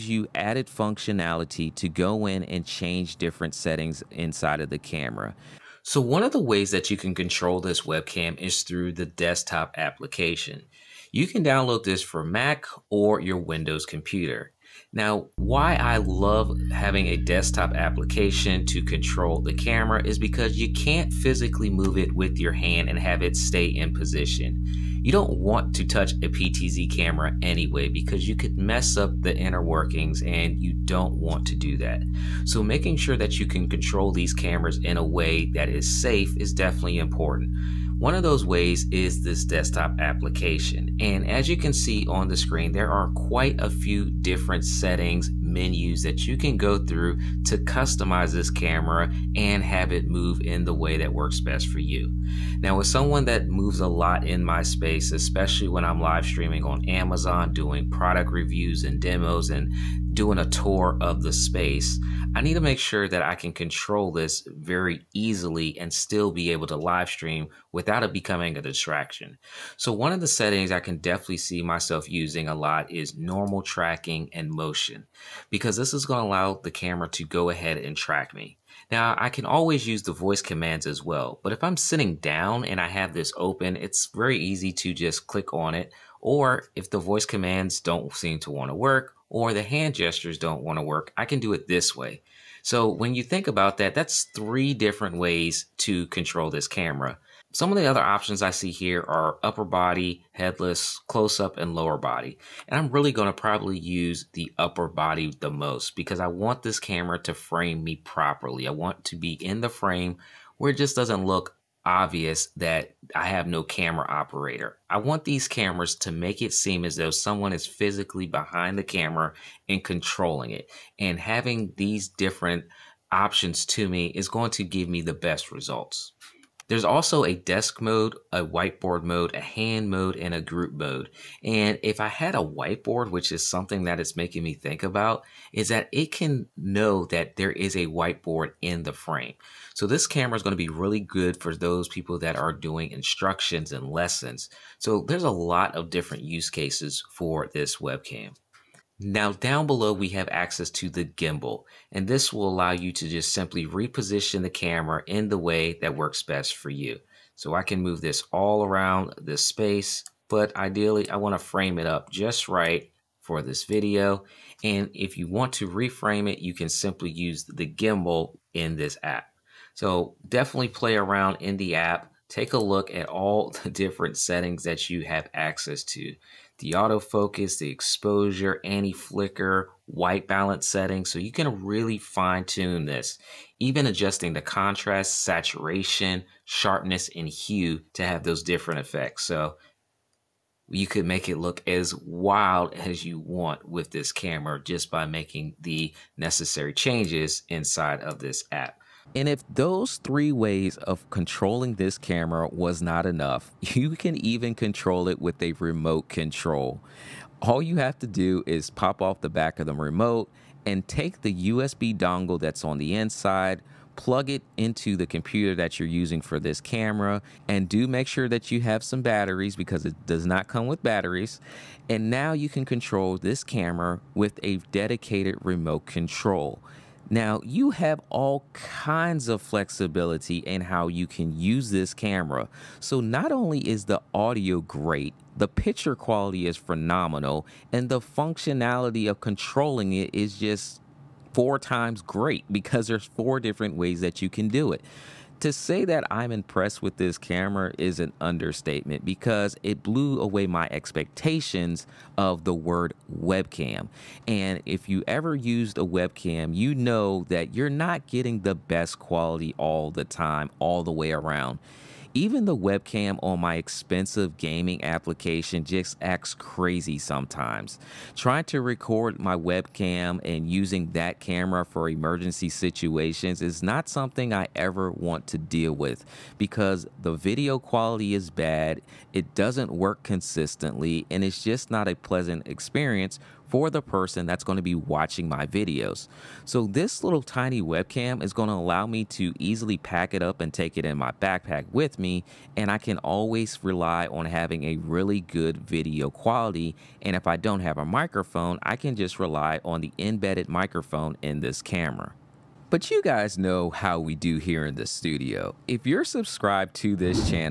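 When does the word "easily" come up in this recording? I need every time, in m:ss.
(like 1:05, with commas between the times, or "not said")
1:05, 4:49.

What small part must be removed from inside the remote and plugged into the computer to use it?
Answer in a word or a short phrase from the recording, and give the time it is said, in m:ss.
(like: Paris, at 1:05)
USB dongle, at 3:31.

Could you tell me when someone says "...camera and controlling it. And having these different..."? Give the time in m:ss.
1:58.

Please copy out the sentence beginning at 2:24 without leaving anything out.
So there's a lot of different use cases for this webcam.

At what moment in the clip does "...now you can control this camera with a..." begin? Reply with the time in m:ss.
3:42.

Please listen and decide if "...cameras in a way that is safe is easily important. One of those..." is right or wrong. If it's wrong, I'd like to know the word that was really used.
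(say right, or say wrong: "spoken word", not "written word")
wrong: "definitely", not "easily".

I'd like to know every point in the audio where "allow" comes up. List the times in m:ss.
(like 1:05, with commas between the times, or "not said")
1:16, 2:32, 4:48.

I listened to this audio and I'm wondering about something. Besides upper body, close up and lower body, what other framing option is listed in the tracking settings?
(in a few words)
Headless.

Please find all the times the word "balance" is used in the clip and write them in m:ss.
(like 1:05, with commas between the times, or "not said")
3:00.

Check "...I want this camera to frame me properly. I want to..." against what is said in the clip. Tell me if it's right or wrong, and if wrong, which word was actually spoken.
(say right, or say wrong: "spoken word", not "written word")
right.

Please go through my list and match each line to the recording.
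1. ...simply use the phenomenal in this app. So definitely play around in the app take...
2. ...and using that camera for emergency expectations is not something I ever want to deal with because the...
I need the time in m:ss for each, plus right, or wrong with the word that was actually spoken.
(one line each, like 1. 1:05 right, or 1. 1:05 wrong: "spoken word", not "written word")
1. 2:46 wrong: "gimbal", not "phenomenal"
2. 4:30 wrong: "situations", not "expectations".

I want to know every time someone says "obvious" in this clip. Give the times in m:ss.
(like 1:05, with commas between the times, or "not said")
1:51.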